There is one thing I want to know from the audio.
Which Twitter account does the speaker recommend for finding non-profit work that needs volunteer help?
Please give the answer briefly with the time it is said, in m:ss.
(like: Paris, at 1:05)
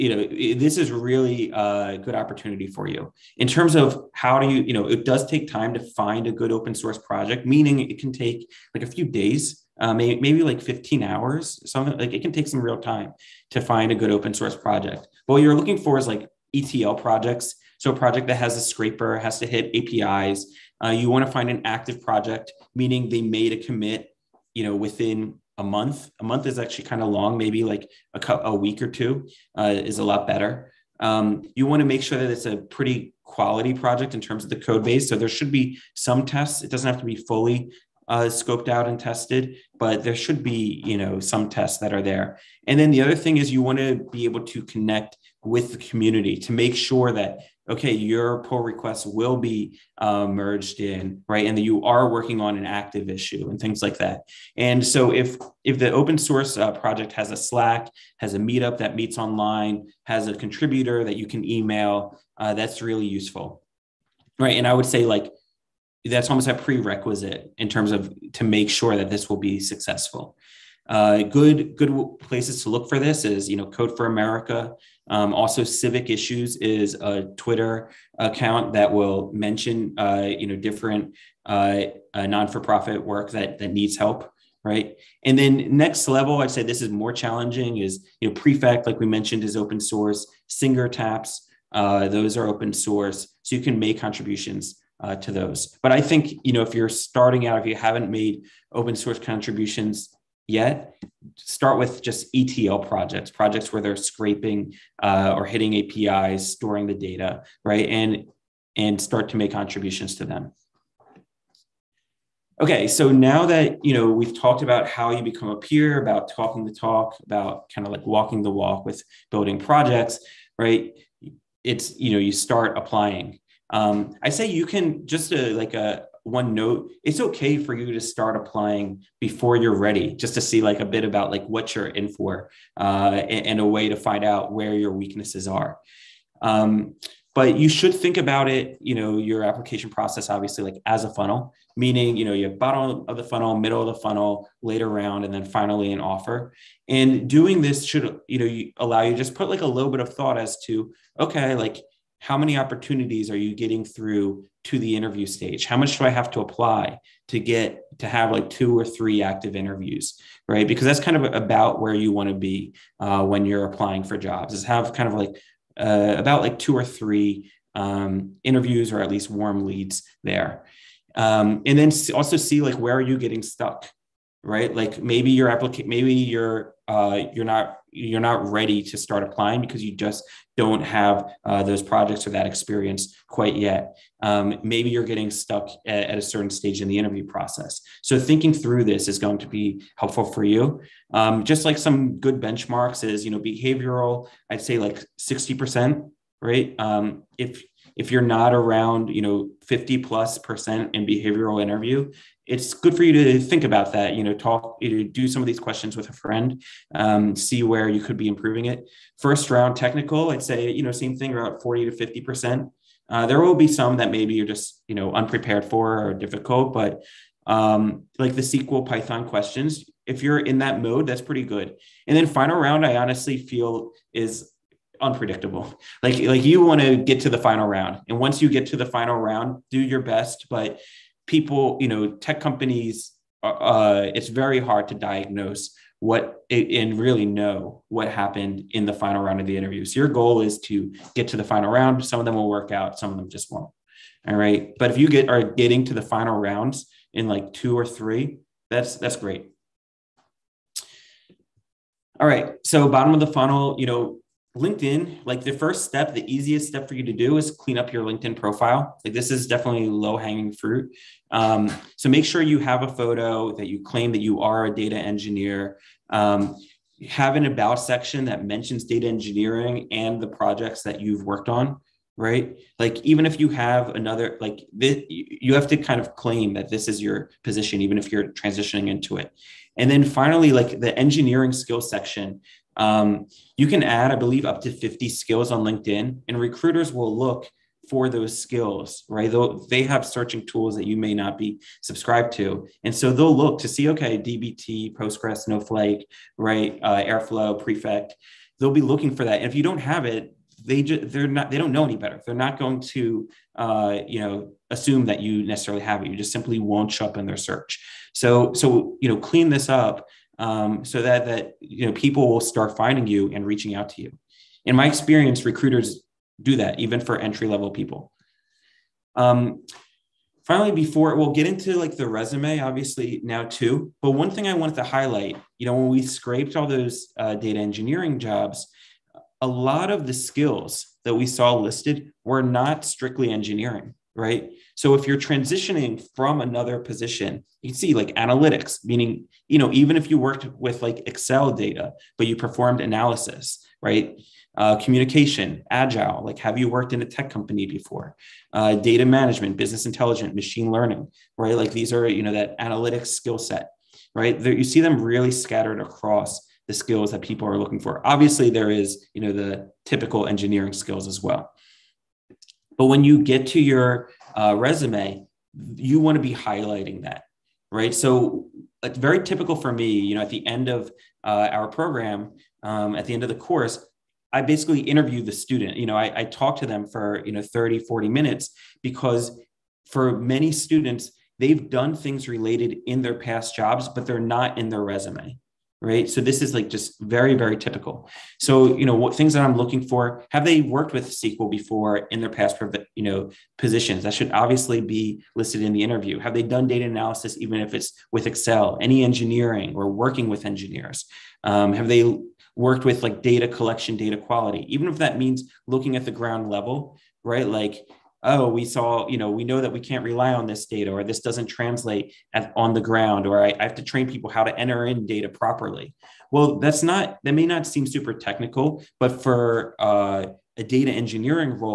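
Civic Issues, at 1:15.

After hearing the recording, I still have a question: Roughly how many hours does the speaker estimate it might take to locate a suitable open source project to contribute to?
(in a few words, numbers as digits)
15 hours.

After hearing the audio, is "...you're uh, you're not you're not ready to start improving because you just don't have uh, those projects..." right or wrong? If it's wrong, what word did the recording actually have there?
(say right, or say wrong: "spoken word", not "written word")
wrong: "applying", not "improving".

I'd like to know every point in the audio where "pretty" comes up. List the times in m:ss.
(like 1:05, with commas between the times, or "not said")
0:32, 3:41.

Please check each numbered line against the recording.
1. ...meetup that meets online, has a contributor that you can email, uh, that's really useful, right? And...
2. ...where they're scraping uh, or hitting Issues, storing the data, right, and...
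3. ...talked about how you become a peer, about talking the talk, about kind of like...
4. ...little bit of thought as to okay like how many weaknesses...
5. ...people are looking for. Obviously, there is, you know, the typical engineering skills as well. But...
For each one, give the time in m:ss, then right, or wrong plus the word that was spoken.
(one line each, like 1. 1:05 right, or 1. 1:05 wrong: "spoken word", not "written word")
1. 0:58 right
2. 1:43 wrong: "APIs", not "Issues"
3. 1:54 right
4. 2:29 wrong: "opportunities", not "weaknesses"
5. 5:57 right.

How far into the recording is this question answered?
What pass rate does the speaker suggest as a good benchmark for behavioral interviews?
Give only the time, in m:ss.
3:15.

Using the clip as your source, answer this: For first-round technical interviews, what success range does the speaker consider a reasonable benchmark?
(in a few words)
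40 to 50 percent.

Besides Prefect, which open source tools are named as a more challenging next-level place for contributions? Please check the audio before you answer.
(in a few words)
Singer Taps.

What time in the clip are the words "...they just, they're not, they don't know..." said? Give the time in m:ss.
5:00.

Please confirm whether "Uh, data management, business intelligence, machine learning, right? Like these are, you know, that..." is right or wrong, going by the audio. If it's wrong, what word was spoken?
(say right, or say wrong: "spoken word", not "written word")
right.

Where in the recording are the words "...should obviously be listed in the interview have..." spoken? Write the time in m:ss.
6:34.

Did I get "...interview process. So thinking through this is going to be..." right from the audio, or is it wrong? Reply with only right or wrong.
right.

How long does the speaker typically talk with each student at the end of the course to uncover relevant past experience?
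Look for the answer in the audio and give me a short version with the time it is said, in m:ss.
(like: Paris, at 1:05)
30 to 40 minutes, at 6:17.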